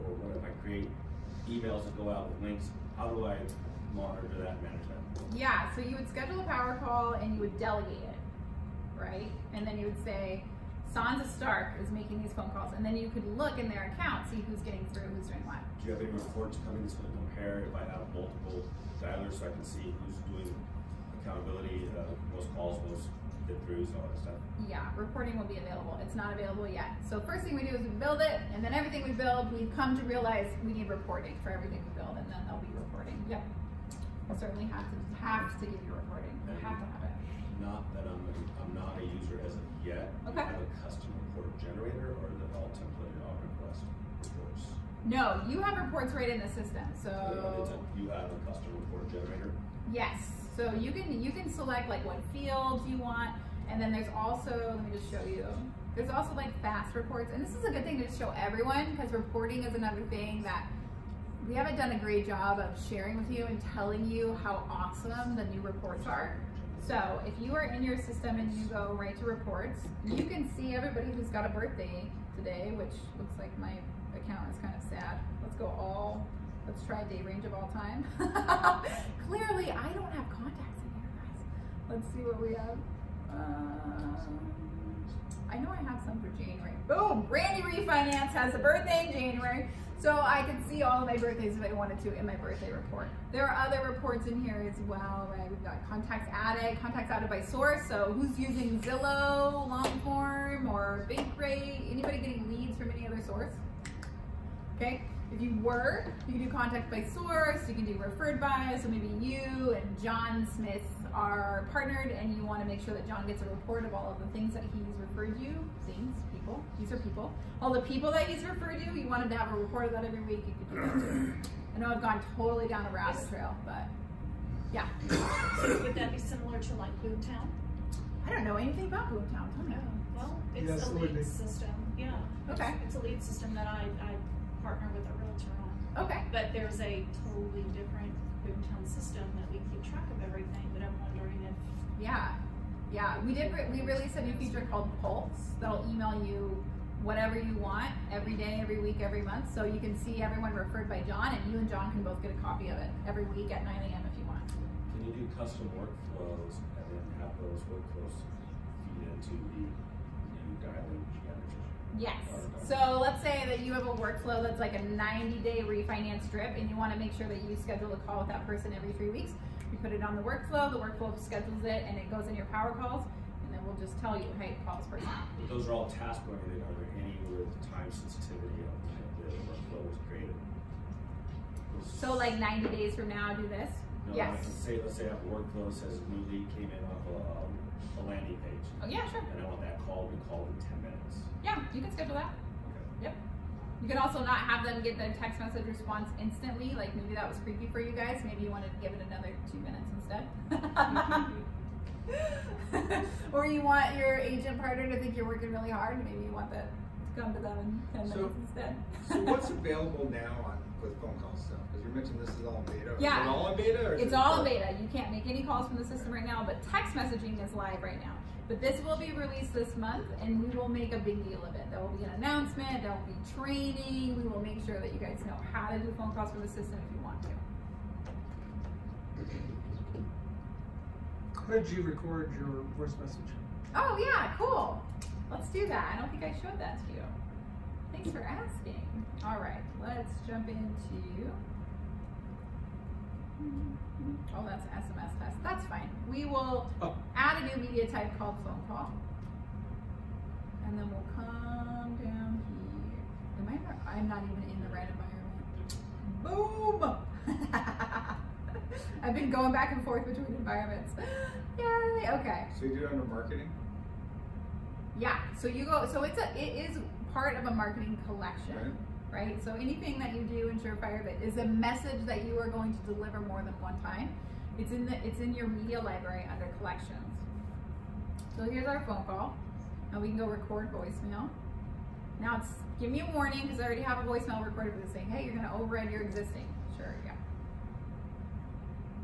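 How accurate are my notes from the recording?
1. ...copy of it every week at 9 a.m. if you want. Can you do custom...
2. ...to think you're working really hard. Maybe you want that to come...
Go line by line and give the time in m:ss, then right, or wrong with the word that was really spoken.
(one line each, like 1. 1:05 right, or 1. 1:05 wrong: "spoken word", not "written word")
1. 2:32 right
2. 3:24 right.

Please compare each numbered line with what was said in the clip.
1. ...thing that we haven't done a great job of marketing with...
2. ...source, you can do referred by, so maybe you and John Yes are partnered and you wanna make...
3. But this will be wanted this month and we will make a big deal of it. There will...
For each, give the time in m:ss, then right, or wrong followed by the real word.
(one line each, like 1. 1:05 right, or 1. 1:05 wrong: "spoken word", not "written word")
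1. 1:00 wrong: "sharing", not "marketing"
2. 1:47 wrong: "Smith", not "Yes"
3. 3:38 wrong: "released", not "wanted".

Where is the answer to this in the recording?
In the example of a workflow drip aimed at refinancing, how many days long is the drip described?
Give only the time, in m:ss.
2:44.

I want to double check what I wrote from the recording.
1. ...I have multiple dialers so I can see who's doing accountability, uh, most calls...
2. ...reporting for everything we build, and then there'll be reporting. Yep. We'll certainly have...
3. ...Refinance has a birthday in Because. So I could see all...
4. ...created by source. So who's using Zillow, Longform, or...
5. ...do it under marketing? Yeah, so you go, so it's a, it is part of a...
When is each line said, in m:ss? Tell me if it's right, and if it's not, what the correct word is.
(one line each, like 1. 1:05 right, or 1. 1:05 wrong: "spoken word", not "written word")
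1. 0:17 right
2. 0:30 right
3. 1:27 wrong: "January", not "Because"
4. 1:37 wrong: "added", not "created"
5. 4:22 right.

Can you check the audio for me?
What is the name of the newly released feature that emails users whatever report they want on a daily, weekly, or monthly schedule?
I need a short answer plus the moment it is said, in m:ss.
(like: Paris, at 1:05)
Pulse, at 2:24.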